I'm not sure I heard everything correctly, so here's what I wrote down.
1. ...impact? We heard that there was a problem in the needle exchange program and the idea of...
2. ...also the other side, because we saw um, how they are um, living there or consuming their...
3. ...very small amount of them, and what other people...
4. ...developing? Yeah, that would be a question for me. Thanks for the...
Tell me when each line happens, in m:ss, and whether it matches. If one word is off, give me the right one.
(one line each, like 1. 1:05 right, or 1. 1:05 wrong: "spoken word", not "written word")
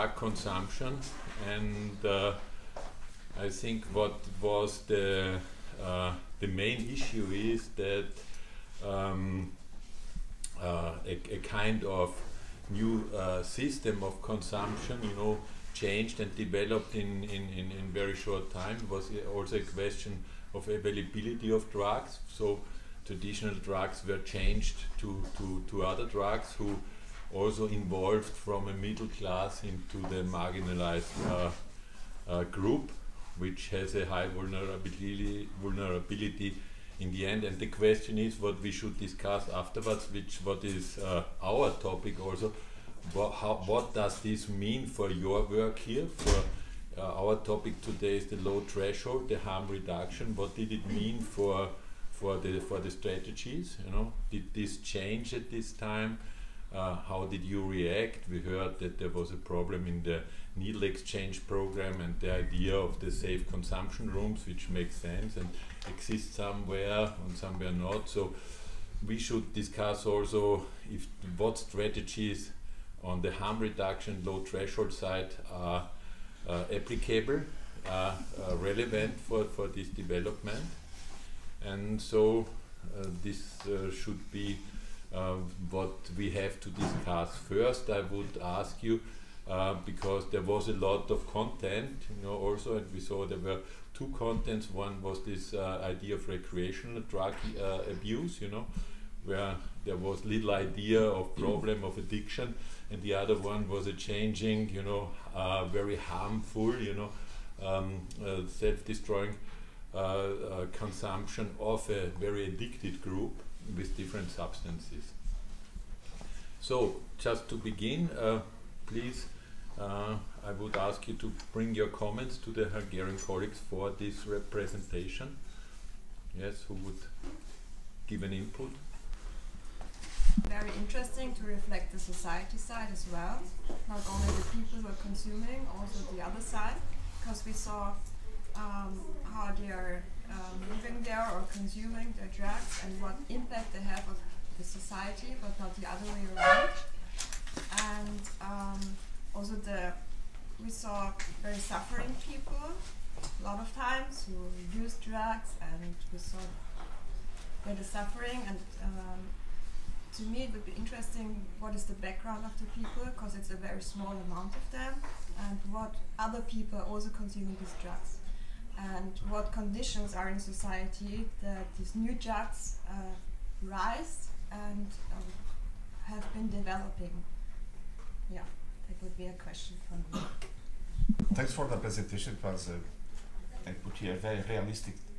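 1. 0:57 wrong: "react", not "impact"
2. 2:15 right
3. 2:43 right
4. 2:56 right.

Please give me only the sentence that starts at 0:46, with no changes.
For uh, our topic today is the low threshold, the harm reduction.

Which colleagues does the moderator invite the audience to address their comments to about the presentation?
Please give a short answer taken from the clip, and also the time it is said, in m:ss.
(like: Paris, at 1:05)
Hungarian colleagues, at 2:02.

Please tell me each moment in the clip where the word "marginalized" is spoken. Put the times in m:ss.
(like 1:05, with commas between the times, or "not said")
0:30.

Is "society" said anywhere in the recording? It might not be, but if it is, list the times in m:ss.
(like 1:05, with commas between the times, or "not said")
2:11, 2:24, 2:50.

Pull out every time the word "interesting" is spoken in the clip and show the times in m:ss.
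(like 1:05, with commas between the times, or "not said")
2:10, 2:40.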